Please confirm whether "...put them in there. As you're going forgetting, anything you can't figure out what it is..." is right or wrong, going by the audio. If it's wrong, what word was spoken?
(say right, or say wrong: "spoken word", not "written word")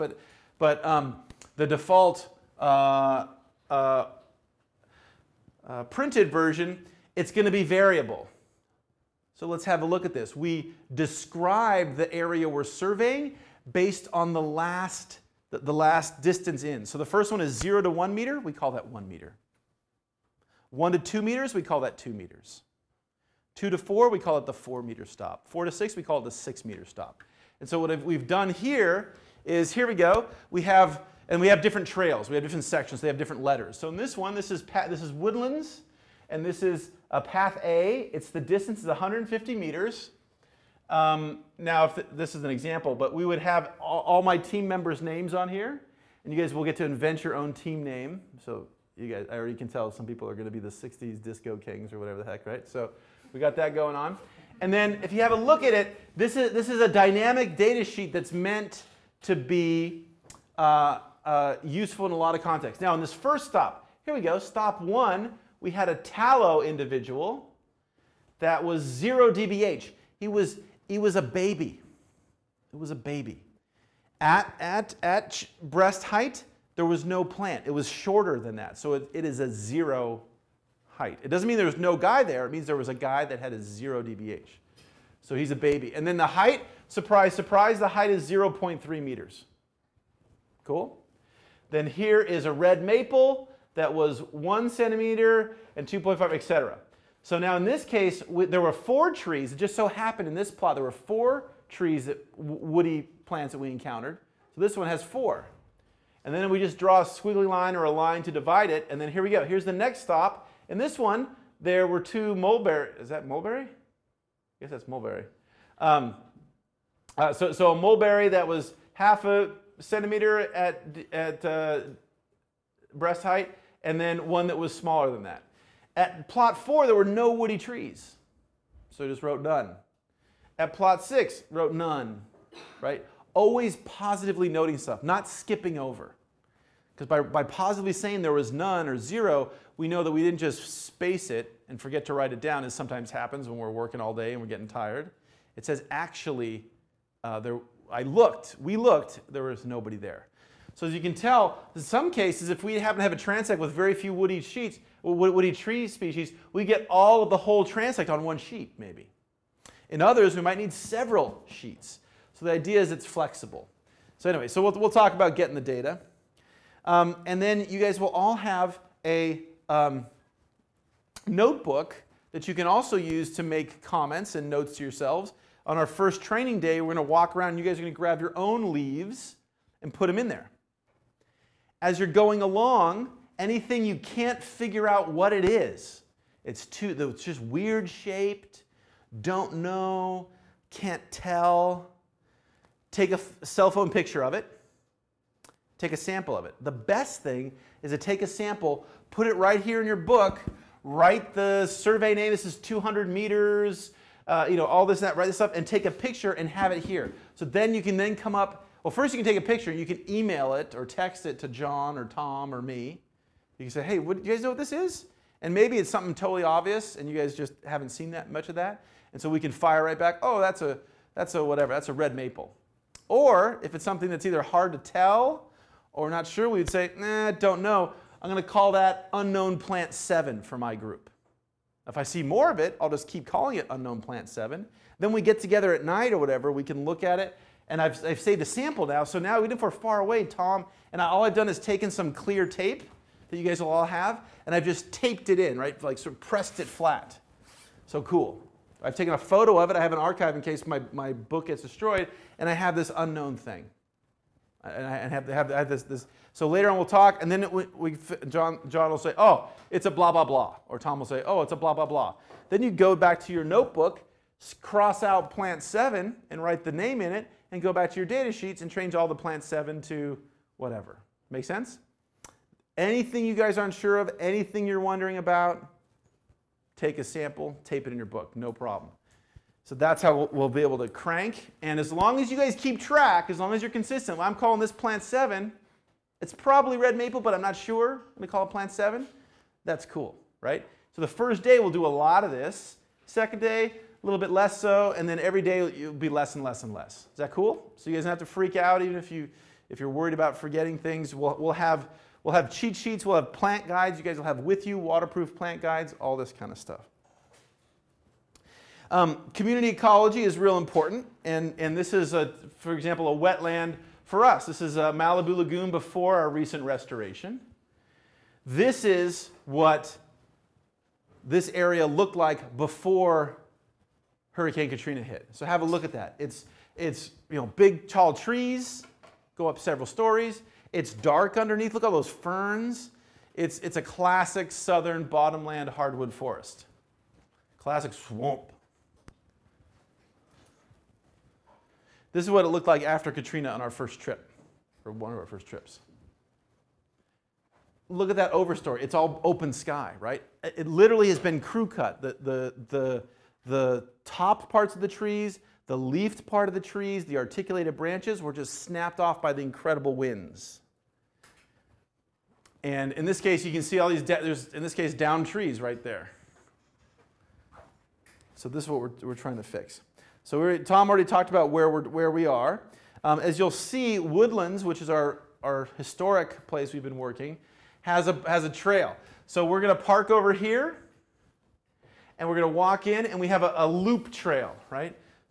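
wrong: "along", not "forgetting".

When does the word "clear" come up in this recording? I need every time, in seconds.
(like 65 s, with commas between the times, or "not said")
242 s.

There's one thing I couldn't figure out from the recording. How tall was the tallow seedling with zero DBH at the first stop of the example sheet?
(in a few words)
0.3 meters.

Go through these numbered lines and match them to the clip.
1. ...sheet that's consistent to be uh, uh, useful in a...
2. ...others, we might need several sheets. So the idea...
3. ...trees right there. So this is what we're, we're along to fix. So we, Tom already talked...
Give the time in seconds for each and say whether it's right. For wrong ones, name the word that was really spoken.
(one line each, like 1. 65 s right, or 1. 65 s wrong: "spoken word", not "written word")
1. 57 s wrong: "meant", not "consistent"
2. 160 s right
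3. 365 s wrong: "trying", not "along".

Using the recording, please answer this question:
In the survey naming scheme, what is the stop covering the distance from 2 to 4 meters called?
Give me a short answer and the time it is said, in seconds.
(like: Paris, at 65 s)
4 meter stop, at 24 s.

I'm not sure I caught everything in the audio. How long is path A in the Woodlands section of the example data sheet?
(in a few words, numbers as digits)
150 meters.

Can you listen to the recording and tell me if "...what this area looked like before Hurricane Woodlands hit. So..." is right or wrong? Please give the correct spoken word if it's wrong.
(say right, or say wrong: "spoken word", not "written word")
wrong: "Katrina", not "Woodlands".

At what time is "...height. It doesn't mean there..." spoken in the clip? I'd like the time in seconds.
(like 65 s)
80 s.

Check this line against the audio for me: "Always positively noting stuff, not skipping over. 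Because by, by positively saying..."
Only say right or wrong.
right.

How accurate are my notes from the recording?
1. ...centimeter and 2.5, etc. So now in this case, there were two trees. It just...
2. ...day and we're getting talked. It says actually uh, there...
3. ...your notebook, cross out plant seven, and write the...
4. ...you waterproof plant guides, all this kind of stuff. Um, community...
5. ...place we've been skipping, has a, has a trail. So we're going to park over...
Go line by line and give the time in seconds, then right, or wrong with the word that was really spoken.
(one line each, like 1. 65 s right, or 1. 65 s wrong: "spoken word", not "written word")
1. 94 s wrong: "four", not "two"
2. 144 s wrong: "tired", not "talked"
3. 263 s right
4. 304 s right
5. 376 s wrong: "working", not "skipping".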